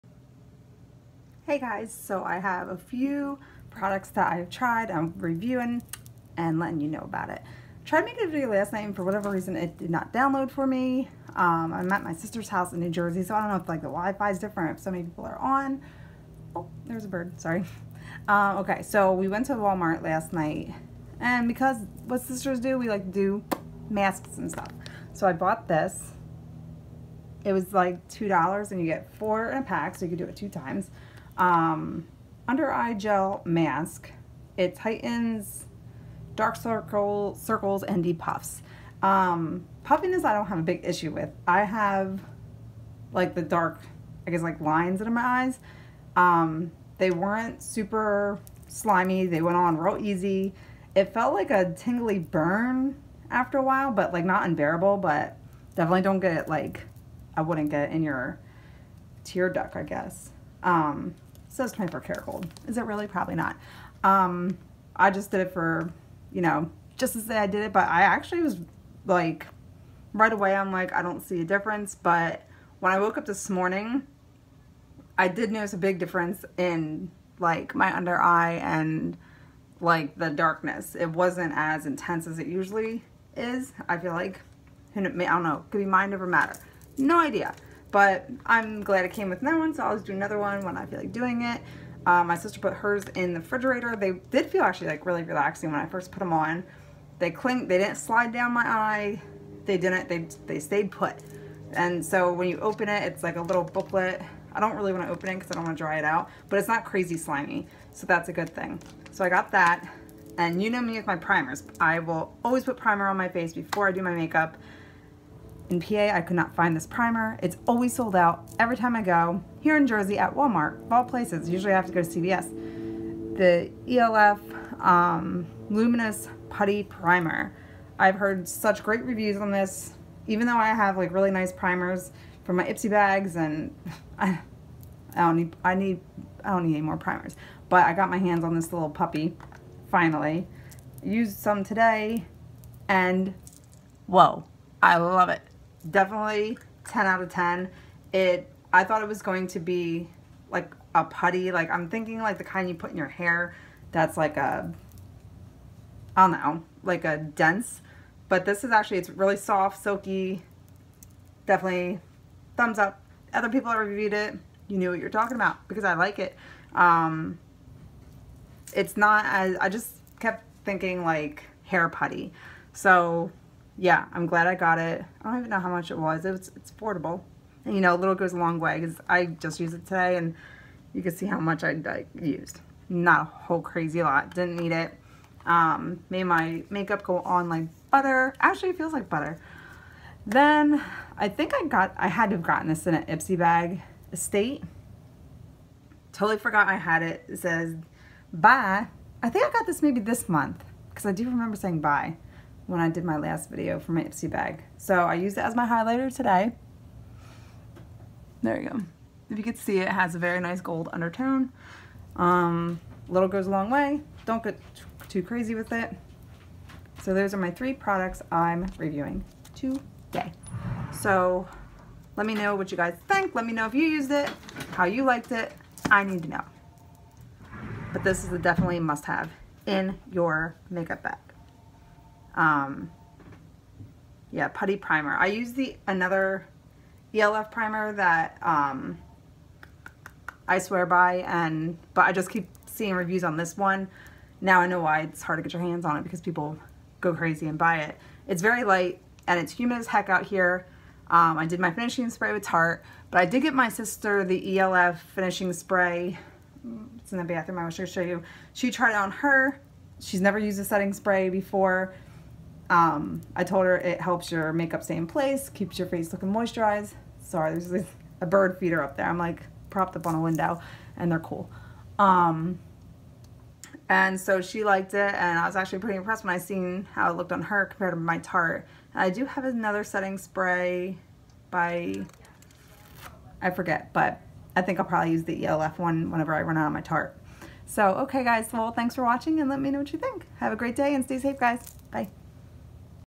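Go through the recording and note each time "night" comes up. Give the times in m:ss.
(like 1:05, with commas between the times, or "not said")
0:08, 0:20.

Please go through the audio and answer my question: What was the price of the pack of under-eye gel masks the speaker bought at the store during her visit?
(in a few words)
$2.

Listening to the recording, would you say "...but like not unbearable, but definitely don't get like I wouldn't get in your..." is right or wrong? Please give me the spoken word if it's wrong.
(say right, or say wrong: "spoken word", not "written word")
right.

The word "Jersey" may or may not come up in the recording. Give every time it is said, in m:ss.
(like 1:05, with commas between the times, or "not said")
0:12, 1:59.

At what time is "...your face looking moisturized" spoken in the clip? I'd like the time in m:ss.
4:25.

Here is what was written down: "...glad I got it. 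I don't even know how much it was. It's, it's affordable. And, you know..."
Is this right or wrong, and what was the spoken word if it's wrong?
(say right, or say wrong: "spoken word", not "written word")
right.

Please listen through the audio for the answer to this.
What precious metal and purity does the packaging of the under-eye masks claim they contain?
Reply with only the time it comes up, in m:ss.
1:01.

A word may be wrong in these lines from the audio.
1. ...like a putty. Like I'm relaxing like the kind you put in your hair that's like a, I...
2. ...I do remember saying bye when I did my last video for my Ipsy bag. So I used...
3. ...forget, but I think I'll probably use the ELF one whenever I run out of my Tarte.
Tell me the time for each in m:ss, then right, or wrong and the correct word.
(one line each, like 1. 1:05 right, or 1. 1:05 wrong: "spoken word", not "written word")
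1. 2:30 wrong: "thinking", not "relaxing"
2. 3:21 right
3. 4:43 right.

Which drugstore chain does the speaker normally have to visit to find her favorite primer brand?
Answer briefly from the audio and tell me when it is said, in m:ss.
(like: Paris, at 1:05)
CVS, at 2:02.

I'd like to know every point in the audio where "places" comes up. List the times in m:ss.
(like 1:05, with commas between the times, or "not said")
2:01, 4:25.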